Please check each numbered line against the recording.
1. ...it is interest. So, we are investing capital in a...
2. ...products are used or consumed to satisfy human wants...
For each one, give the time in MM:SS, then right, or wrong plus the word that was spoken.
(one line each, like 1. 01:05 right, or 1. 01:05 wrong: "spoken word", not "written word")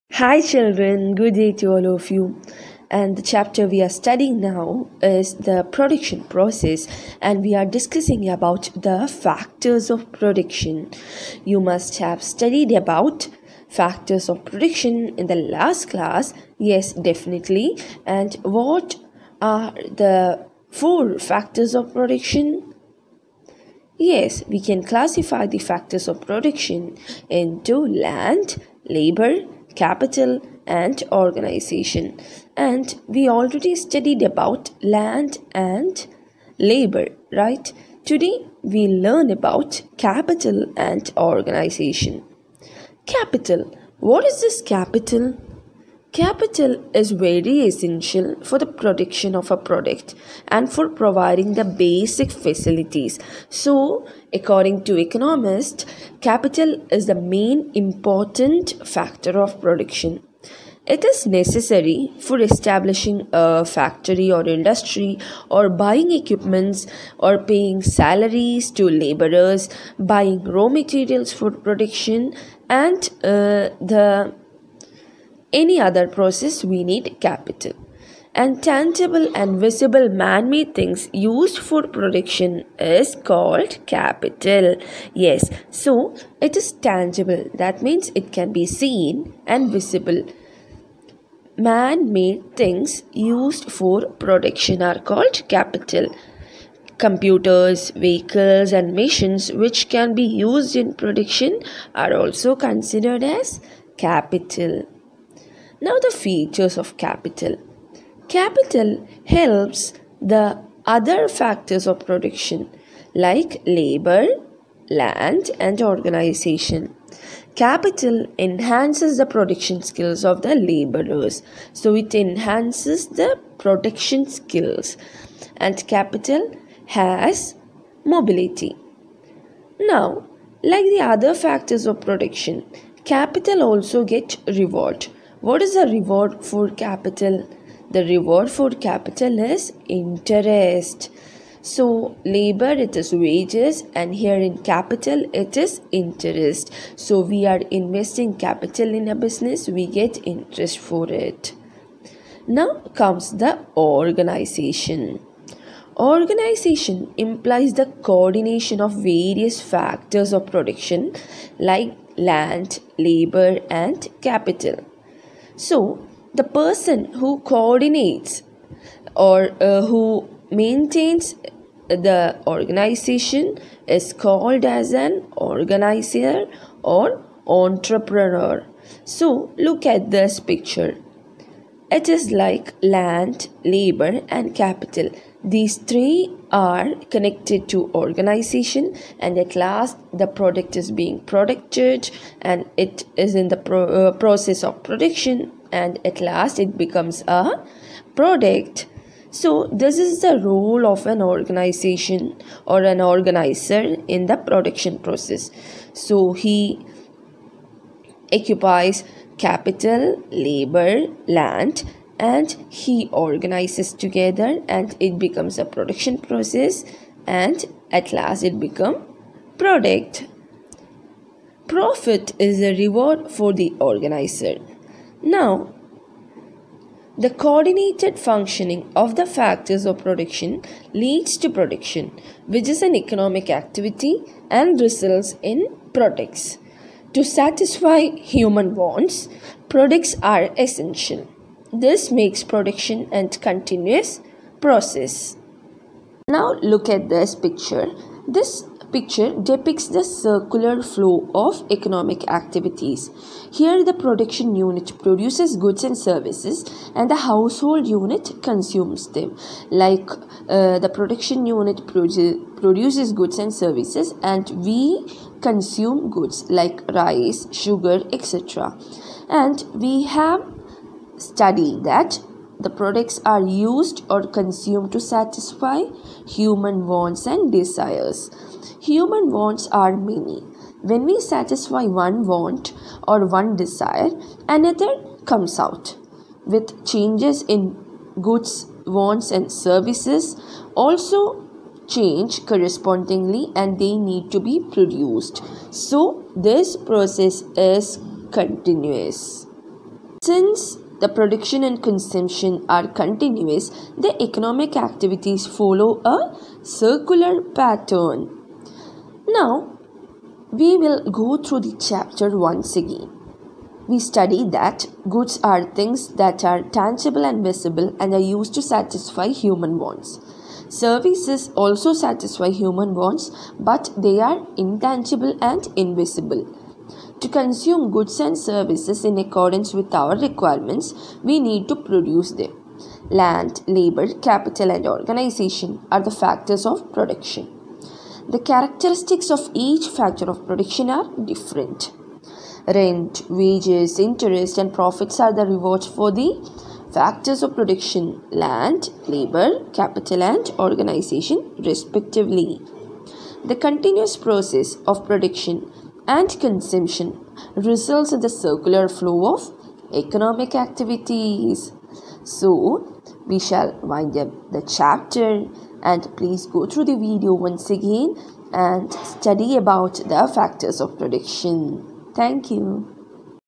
1. 02:25 right
2. 04:32 right.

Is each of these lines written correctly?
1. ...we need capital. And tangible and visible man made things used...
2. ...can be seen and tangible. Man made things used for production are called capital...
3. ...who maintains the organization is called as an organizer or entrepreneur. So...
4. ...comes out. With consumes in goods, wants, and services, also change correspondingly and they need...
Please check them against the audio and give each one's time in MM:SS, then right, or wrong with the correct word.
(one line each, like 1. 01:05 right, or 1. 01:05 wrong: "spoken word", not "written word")
1. 01:16 right
2. 01:28 wrong: "visible", not "tangible"
3. 02:49 right
4. 04:45 wrong: "changes", not "consumes".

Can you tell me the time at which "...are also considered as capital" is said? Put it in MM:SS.
01:41.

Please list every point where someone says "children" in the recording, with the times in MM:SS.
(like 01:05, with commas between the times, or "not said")
00:00.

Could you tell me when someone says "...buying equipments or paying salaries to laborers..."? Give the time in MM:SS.
01:05.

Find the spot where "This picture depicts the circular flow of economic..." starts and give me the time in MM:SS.
04:08.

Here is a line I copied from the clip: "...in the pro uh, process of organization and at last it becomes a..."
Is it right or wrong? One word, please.
wrong.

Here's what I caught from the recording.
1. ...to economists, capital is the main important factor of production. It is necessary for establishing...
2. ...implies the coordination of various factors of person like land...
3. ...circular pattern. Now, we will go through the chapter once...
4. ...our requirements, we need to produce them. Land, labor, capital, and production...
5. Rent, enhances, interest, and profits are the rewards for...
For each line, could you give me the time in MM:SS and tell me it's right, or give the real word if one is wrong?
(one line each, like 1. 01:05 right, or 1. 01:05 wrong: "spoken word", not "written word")
1. 00:54 right
2. 02:37 wrong: "production", not "person"
3. 05:06 right
4. 05:30 wrong: "organization", not "production"
5. 05:42 wrong: "wages", not "enhances".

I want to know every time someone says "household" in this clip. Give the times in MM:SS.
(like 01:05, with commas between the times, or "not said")
04:17.